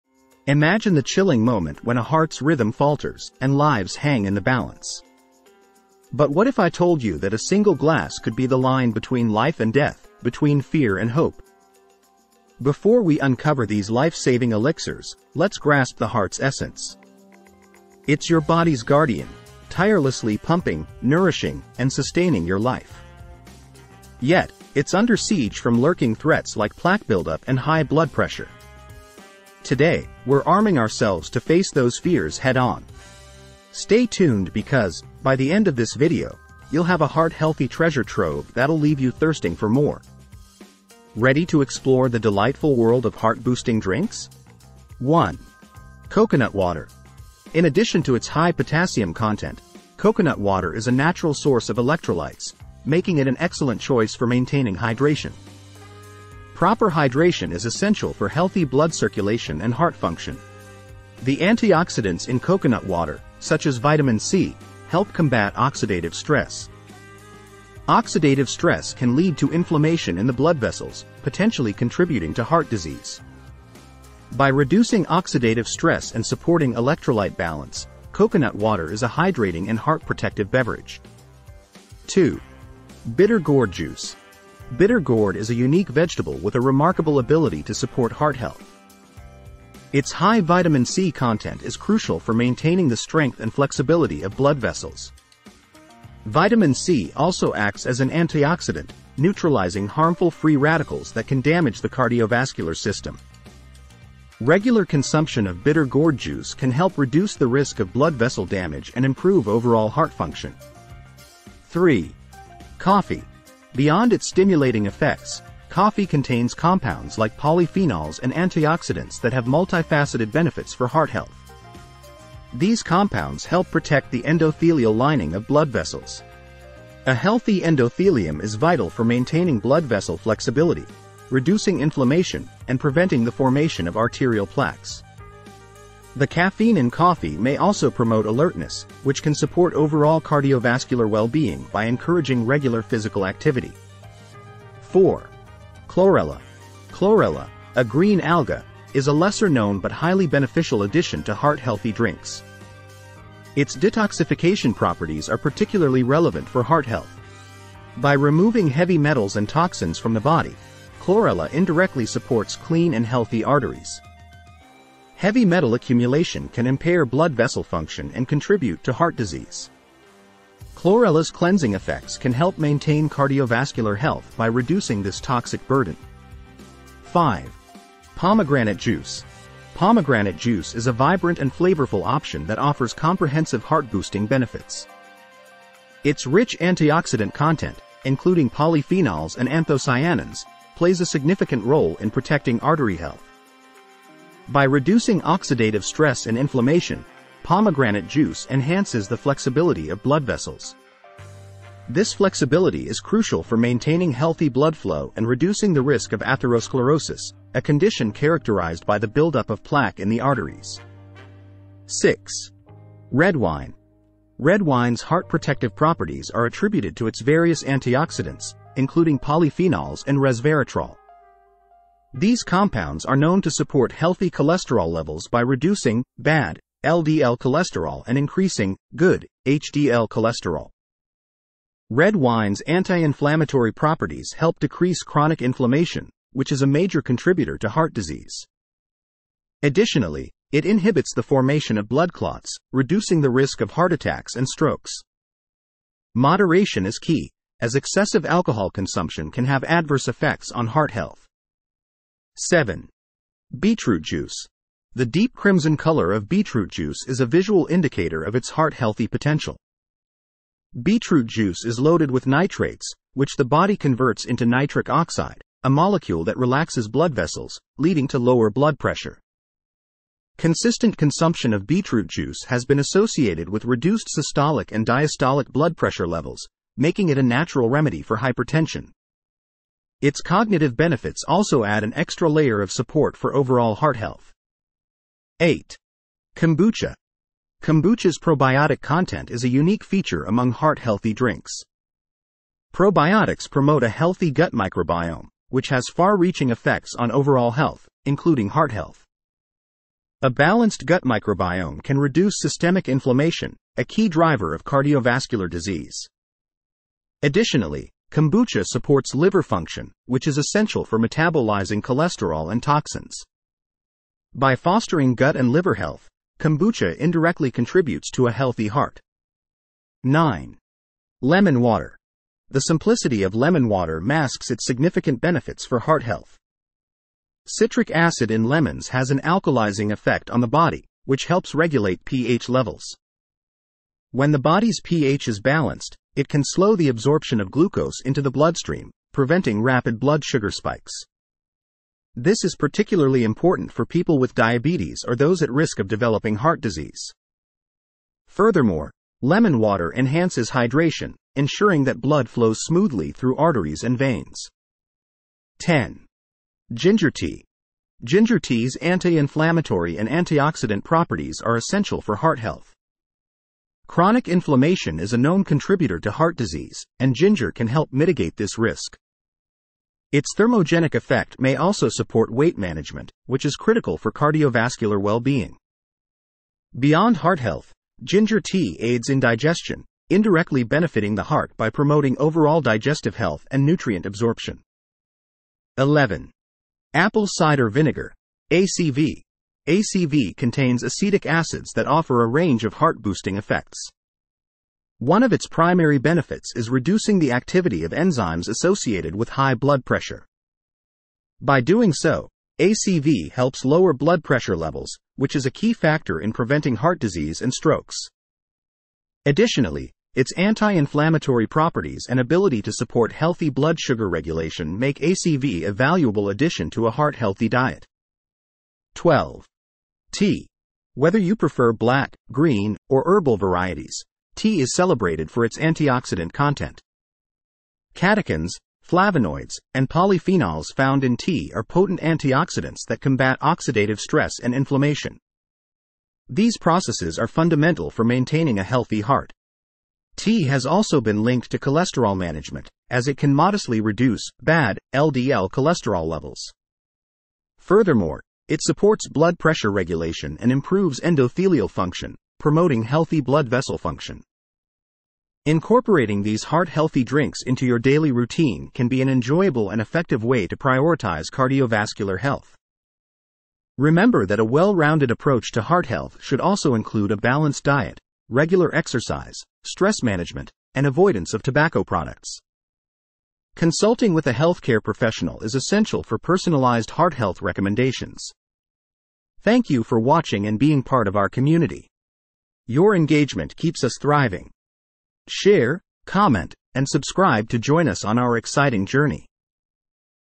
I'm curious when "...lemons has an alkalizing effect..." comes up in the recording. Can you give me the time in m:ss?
5:28.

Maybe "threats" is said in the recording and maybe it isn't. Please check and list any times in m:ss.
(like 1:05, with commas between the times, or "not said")
0:26.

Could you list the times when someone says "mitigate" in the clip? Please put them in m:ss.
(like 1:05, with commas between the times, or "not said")
6:07.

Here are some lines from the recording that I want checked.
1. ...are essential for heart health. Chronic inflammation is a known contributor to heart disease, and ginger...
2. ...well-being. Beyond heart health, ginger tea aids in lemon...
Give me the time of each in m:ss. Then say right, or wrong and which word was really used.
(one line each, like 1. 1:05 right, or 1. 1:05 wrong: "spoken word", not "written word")
1. 6:01 right
2. 6:14 wrong: "digestion", not "lemon".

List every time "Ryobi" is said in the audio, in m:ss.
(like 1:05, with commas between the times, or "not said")
not said.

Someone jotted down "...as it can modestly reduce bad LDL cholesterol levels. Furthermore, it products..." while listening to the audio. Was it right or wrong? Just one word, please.
wrong.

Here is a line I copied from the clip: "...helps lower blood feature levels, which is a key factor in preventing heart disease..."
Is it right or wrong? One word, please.
wrong.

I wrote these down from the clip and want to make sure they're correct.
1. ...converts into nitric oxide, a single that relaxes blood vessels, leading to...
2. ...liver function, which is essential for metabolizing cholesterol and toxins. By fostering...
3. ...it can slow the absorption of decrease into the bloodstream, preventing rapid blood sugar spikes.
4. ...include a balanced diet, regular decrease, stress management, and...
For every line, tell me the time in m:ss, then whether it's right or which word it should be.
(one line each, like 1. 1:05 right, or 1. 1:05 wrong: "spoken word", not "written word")
1. 4:23 wrong: "molecule", not "single"
2. 5:09 right
3. 5:36 wrong: "glucose", not "decrease"
4. 7:46 wrong: "exercise", not "decrease".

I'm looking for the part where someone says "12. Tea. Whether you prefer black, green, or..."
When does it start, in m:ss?
6:58.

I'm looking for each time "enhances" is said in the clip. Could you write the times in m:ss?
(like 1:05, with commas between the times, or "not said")
3:18, 5:49.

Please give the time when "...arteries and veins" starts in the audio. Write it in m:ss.
5:53.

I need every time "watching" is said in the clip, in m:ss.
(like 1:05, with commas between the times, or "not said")
7:59.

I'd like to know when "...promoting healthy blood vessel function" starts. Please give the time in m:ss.
7:32.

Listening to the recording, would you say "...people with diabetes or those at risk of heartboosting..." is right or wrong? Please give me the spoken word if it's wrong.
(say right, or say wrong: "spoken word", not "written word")
wrong: "developing", not "heartboosting".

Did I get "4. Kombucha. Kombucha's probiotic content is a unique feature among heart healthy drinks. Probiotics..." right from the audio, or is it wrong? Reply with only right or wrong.
wrong.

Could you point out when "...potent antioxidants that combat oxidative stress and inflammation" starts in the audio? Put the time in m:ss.
7:11.